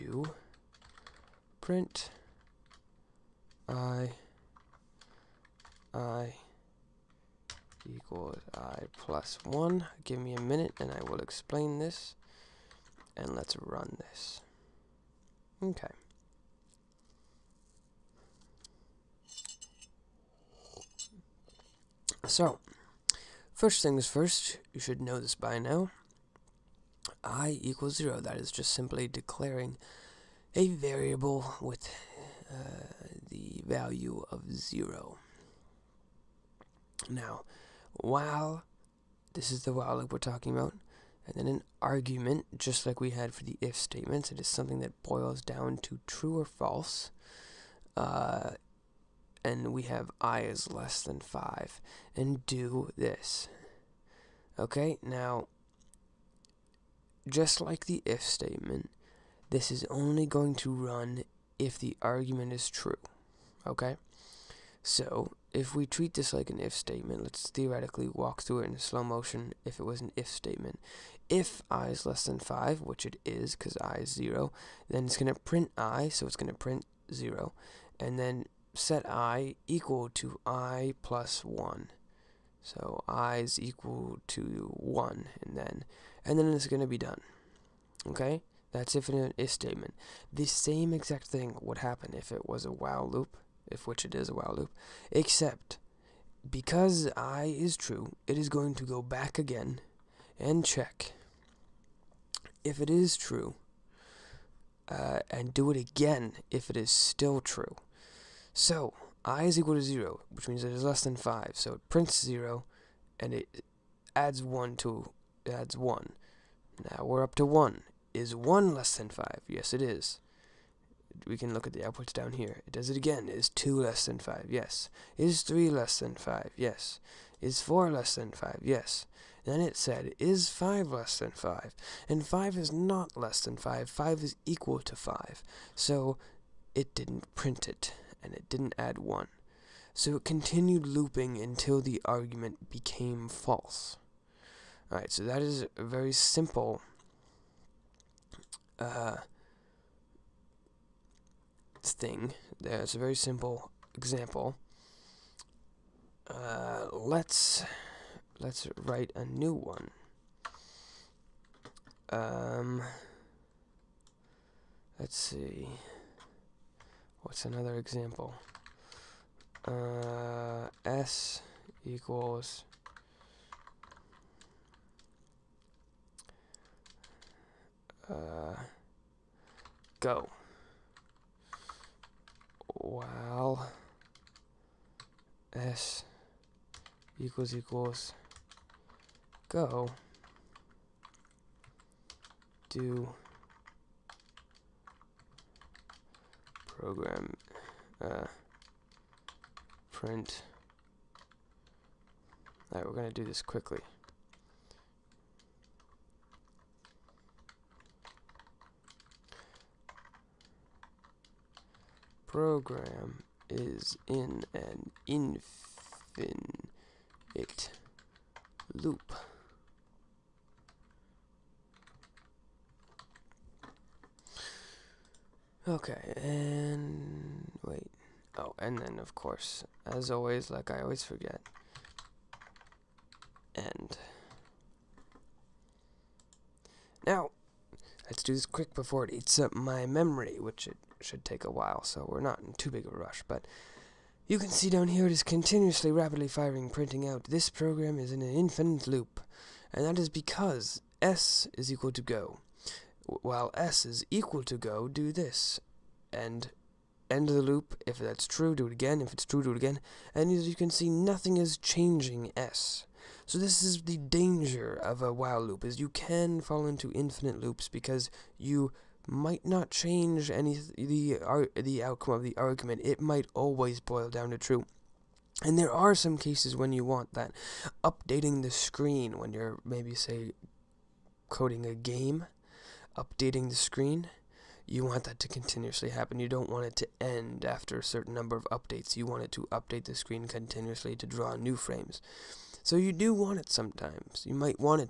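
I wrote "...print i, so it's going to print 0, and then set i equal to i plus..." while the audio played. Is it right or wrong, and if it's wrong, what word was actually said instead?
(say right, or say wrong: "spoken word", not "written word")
right.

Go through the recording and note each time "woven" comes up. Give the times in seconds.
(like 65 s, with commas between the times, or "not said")
not said.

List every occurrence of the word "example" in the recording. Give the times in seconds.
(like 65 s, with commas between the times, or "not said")
153 s, 167 s.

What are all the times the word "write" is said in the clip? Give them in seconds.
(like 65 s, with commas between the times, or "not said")
158 s.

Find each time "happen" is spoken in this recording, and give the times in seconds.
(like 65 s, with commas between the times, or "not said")
91 s, 285 s.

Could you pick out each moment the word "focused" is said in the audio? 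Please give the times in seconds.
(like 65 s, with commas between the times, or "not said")
not said.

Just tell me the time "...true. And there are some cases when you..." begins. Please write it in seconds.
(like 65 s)
274 s.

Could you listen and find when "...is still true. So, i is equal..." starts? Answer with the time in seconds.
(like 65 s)
106 s.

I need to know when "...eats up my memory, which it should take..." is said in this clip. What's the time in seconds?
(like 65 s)
239 s.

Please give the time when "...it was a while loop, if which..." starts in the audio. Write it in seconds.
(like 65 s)
92 s.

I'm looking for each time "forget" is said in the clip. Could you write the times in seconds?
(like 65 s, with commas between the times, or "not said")
231 s.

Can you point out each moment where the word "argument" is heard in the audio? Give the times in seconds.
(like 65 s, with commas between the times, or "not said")
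41 s, 62 s, 142 s, 272 s.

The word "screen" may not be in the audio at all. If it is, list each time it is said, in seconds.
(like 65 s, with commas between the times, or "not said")
278 s, 283 s, 289 s.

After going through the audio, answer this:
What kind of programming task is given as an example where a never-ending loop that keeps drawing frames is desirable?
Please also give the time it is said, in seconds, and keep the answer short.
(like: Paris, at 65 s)
coding a game, at 281 s.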